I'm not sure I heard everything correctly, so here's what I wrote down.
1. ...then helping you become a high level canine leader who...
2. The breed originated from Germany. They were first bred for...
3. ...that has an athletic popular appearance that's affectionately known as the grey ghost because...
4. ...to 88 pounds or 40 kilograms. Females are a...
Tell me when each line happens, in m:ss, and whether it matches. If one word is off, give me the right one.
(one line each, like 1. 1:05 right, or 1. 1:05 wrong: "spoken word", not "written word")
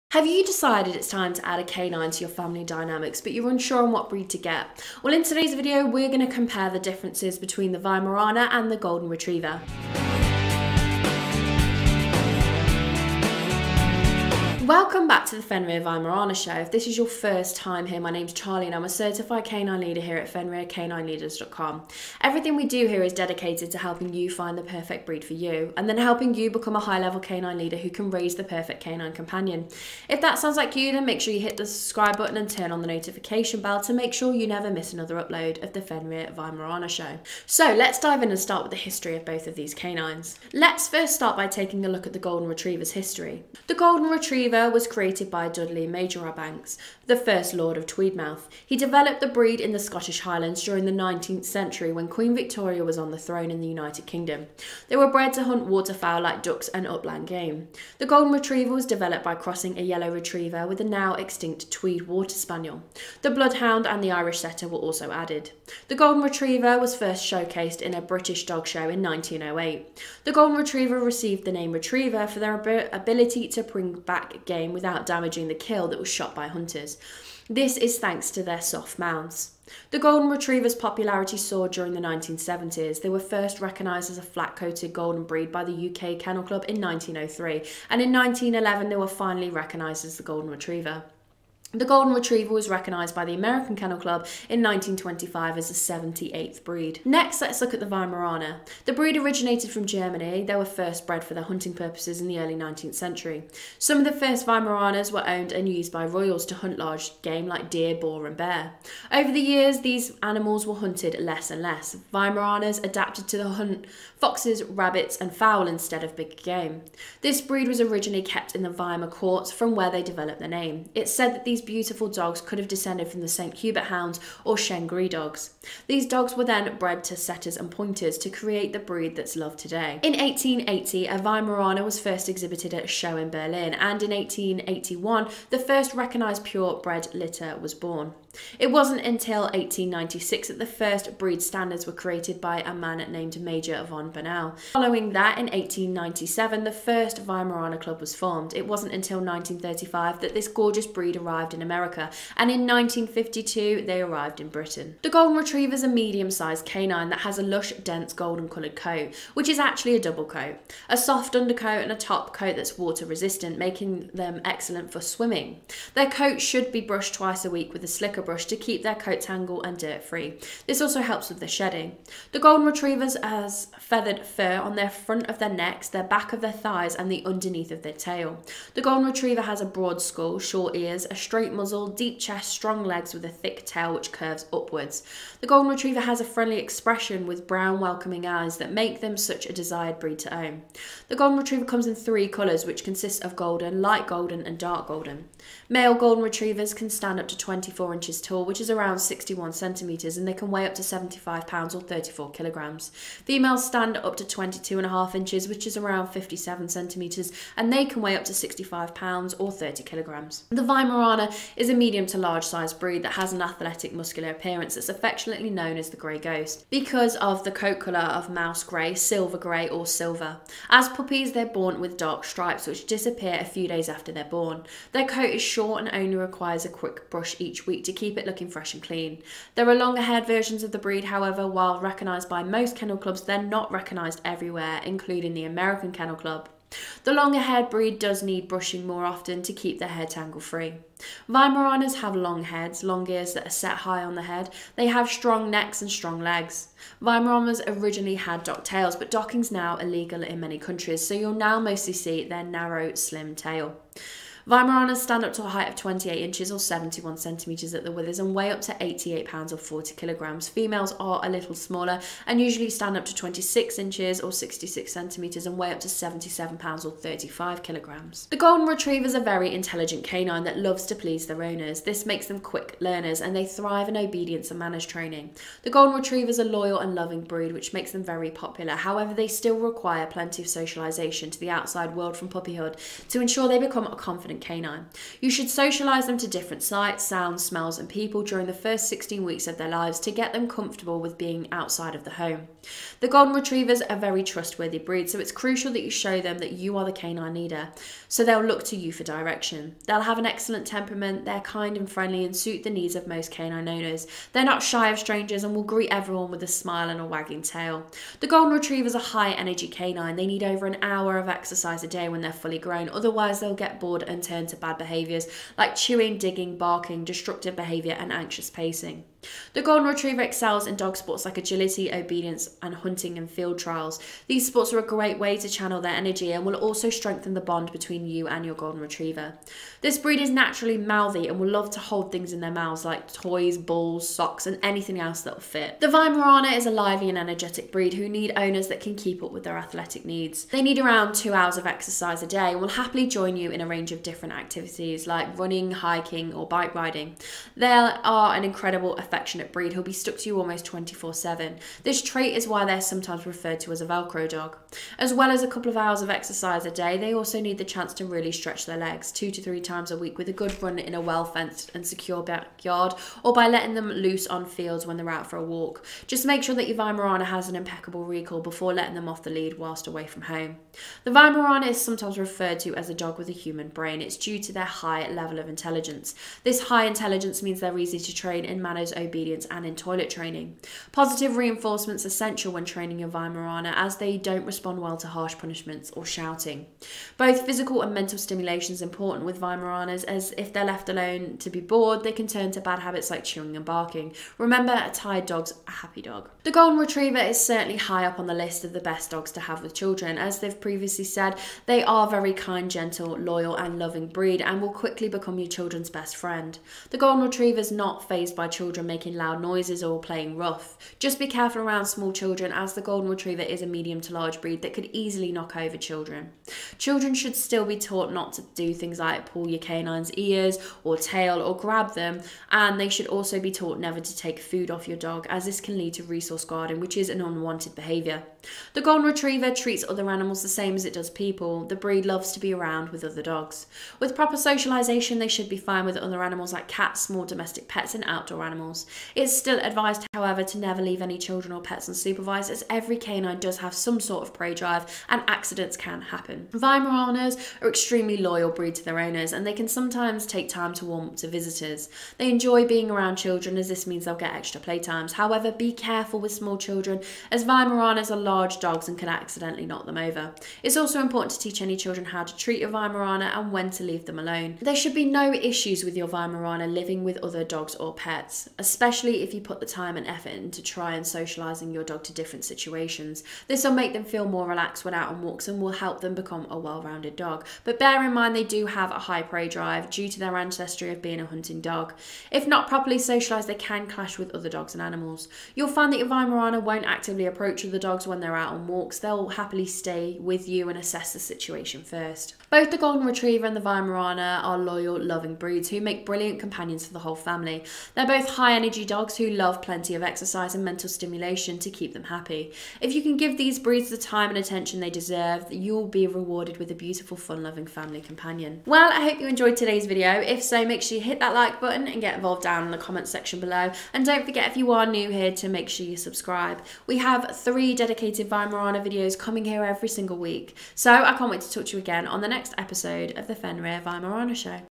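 1. 0:25 right
2. 1:38 right
3. 3:33 wrong: "muscular", not "popular"
4. 4:18 right.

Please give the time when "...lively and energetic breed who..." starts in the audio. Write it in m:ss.
5:36.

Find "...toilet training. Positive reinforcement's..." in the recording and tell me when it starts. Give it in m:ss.
6:19.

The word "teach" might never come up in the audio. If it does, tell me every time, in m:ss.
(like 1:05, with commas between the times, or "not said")
7:41.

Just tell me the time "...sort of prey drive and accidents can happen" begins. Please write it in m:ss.
7:23.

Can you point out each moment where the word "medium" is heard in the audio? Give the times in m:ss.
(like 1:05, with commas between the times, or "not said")
2:35, 3:31, 6:53.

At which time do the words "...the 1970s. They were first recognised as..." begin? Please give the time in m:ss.
1:21.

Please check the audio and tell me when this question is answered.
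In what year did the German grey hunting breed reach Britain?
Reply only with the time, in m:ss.
2:32.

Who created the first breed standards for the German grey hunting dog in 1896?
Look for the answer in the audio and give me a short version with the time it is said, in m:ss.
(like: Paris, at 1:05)
Major von Bernau, at 2:23.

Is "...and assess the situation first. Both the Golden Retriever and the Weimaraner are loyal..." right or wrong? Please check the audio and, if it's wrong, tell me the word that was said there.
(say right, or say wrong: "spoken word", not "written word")
right.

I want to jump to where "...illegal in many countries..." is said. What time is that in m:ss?
4:09.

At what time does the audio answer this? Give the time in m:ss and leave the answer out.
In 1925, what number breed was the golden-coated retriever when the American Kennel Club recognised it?
1:35.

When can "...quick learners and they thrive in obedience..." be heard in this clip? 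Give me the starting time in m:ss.
4:32.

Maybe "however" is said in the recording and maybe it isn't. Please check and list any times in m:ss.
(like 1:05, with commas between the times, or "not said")
3:51, 4:38, 7:20, 7:35.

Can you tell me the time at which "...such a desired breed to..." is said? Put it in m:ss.
3:09.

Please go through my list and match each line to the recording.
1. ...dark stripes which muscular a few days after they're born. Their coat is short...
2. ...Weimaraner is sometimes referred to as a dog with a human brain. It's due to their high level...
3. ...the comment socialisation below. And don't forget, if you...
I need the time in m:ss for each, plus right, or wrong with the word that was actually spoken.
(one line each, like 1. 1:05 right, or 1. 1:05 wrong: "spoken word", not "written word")
1. 3:41 wrong: "disappear", not "muscular"
2. 6:11 right
3. 8:32 wrong: "section", not "socialisation".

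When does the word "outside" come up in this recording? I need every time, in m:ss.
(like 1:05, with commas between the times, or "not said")
4:41, 4:51.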